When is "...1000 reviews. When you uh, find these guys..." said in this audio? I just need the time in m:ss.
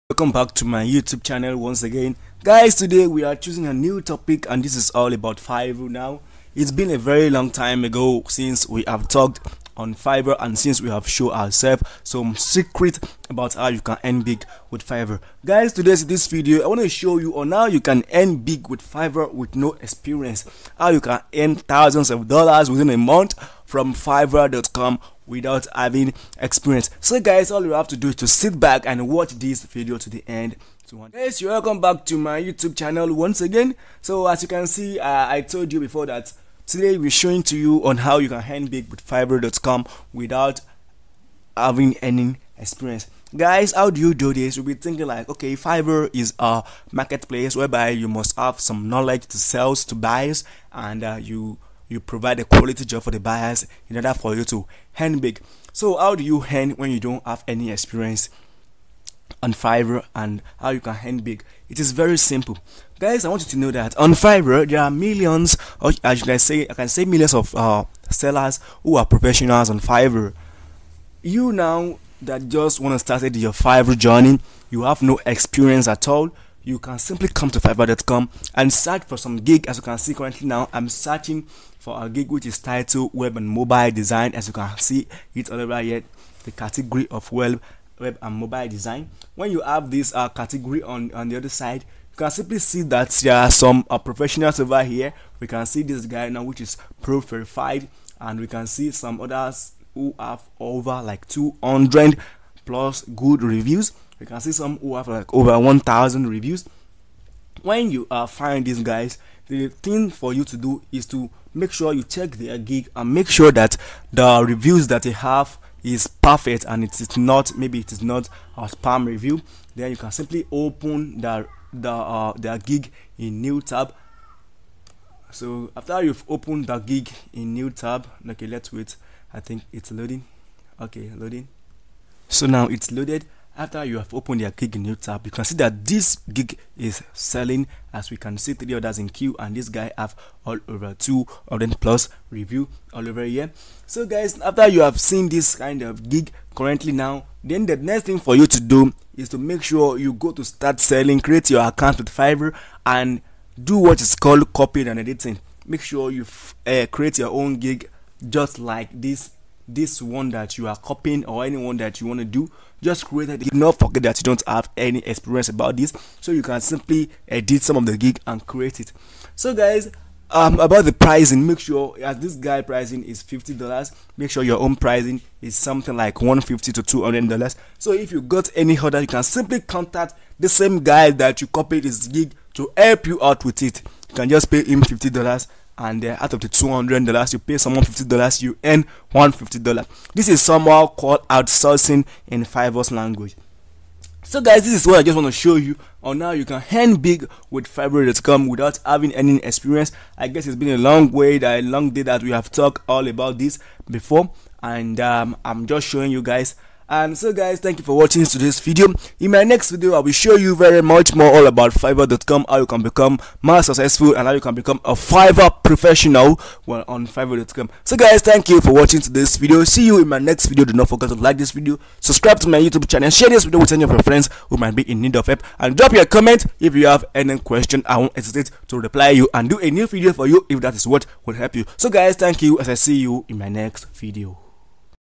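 1:45.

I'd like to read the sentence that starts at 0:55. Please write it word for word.
So how do you earn when you don't have any experience on Fiverr and how you can earn big?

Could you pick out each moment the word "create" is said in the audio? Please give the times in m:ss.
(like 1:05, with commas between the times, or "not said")
2:31, 2:36, 2:43, 2:48.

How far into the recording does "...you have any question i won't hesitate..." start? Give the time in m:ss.
3:46.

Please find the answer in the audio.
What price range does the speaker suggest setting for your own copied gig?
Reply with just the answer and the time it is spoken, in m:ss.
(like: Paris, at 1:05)
$150 to $200, at 2:56.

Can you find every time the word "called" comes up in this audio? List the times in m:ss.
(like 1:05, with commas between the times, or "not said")
2:34, 3:10.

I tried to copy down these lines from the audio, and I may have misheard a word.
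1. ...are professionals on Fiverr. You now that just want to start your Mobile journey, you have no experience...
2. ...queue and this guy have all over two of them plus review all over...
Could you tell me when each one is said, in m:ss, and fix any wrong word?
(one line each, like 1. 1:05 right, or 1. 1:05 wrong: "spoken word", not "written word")
1. 1:08 wrong: "Fiverr", not "Mobile"
2. 2:19 right.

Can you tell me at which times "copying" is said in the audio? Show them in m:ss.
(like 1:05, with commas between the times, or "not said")
2:34, 2:40.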